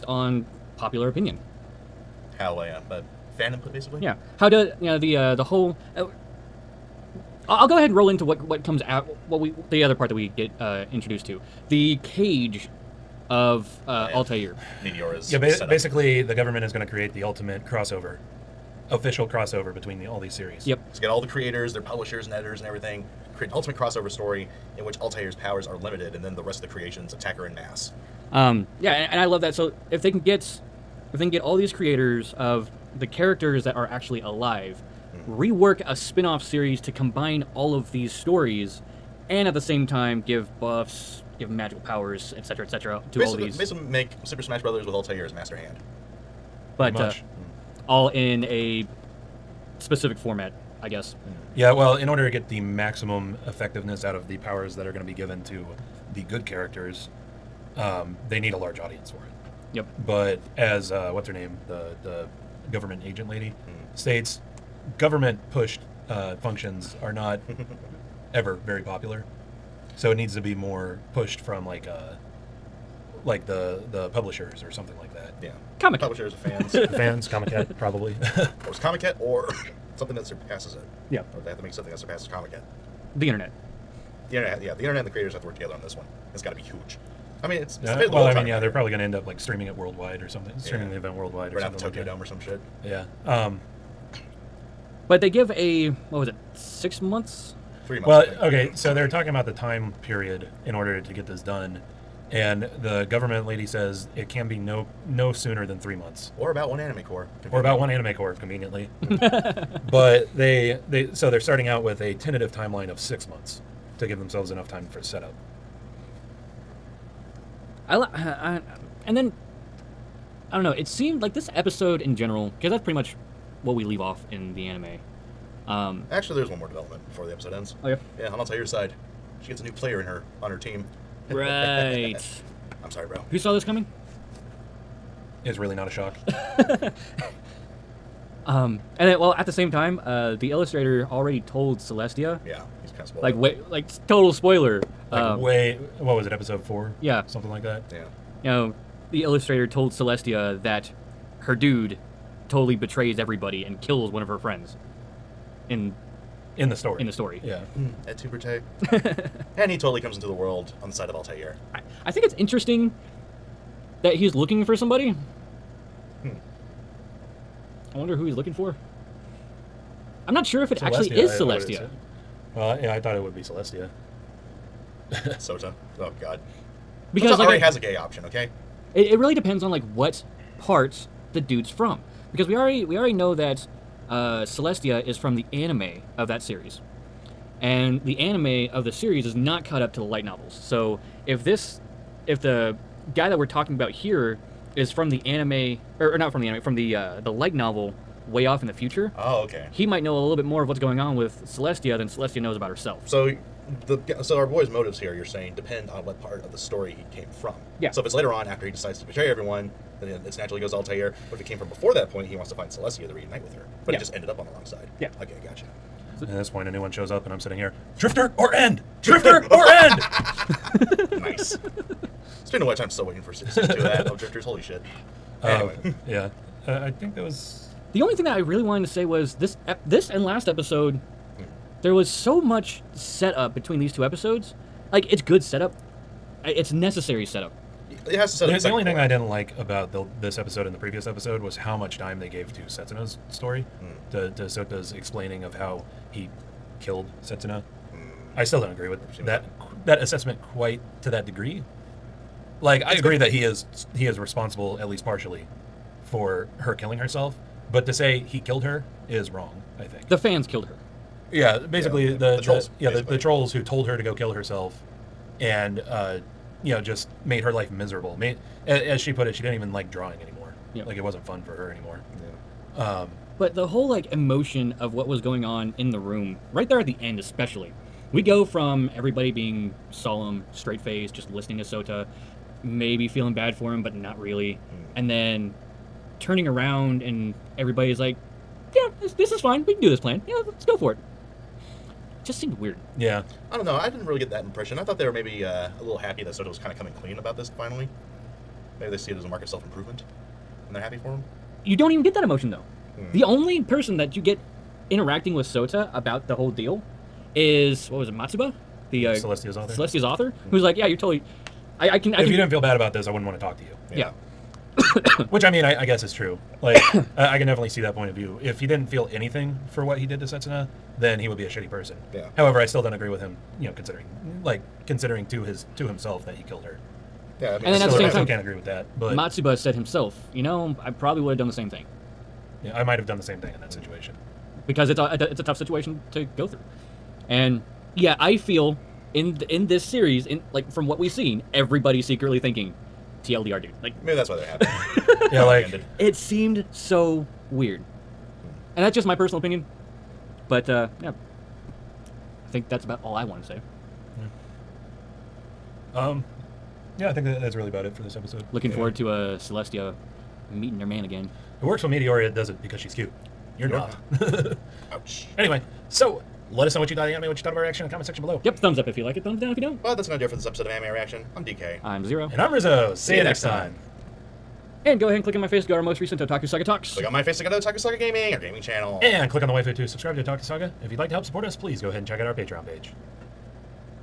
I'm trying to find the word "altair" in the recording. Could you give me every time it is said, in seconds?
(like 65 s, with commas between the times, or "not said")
14 s, 25 s, 44 s, 161 s, 210 s.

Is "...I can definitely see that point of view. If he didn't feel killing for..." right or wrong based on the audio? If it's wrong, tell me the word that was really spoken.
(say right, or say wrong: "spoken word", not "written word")
wrong: "anything", not "killing".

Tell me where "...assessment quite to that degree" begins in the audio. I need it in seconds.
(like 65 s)
249 s.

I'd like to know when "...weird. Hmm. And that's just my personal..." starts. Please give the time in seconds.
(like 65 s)
347 s.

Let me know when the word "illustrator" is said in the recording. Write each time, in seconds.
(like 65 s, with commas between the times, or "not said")
140 s, 149 s.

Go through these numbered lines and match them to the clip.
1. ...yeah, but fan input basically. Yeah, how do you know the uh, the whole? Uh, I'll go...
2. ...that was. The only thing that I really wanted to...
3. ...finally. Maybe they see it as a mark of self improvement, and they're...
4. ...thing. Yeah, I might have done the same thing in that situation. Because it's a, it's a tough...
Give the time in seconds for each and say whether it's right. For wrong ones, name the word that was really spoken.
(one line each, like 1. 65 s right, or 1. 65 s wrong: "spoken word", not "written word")
1. 2 s right
2. 227 s right
3. 297 s right
4. 331 s right.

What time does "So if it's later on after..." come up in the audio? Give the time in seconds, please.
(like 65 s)
207 s.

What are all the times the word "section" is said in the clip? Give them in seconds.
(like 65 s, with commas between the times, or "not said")
368 s.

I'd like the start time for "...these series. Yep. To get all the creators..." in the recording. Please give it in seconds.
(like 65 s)
20 s.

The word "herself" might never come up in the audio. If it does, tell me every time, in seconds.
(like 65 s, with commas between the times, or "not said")
202 s, 256 s, 264 s.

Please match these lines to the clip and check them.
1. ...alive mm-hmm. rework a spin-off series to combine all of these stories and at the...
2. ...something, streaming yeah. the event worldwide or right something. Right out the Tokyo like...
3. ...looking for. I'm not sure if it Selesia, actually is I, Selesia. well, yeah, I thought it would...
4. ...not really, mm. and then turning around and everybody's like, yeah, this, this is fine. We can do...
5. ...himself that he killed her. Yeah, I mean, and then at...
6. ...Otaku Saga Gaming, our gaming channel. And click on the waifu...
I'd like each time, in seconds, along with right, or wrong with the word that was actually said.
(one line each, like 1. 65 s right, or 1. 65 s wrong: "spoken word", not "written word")
1. 34 s right
2. 90 s right
3. 168 s right
4. 283 s right
5. 325 s right
6. 377 s right.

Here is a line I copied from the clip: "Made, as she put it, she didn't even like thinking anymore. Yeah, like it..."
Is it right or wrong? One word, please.
wrong.